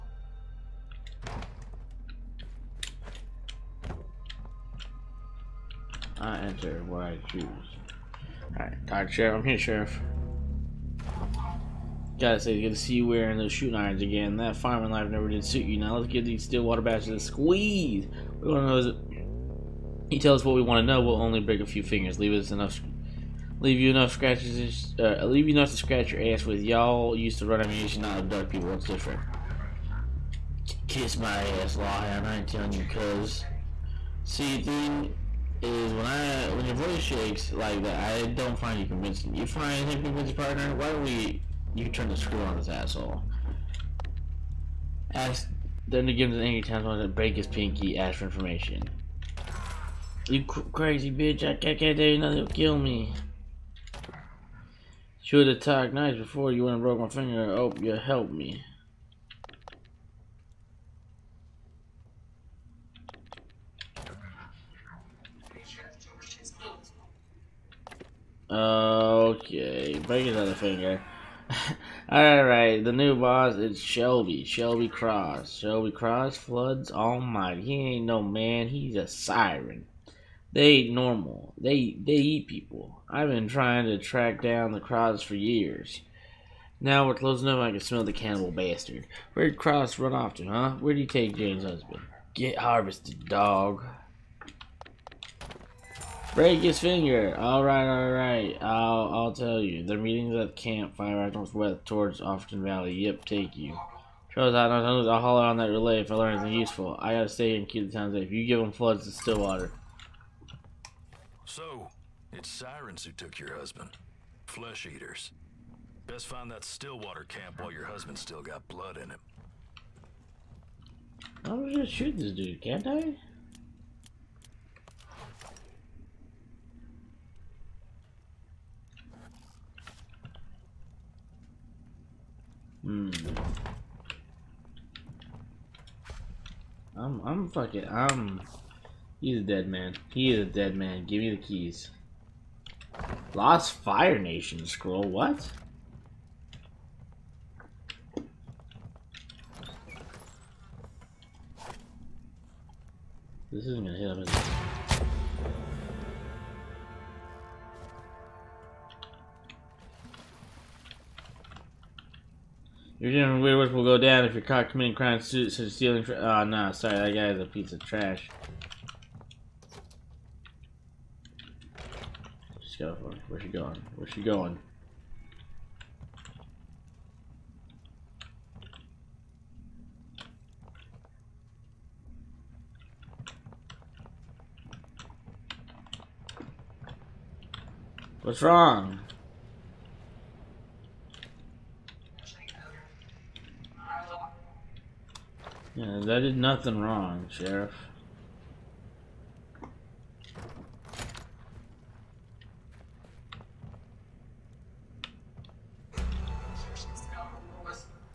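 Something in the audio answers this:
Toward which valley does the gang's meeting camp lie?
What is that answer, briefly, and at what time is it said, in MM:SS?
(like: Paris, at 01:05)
Offerton Valley, at 01:42.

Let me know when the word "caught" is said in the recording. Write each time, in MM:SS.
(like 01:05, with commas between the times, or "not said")
02:44.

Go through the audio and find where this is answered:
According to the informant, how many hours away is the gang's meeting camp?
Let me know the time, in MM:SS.
01:40.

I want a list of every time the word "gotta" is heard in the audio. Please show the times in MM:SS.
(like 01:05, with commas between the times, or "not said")
00:12, 01:47.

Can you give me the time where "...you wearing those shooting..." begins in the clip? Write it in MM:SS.
00:12.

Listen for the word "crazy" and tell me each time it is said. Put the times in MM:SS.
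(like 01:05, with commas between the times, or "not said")
00:50.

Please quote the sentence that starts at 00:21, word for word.
We'll only break a few fingers.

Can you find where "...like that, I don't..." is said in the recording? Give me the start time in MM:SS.
00:37.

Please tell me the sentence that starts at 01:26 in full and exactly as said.
Now we're close enough I can smell the cannibal bastard.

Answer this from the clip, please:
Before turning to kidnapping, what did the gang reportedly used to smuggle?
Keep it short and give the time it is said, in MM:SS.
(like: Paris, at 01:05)
Ammunition, at 00:27.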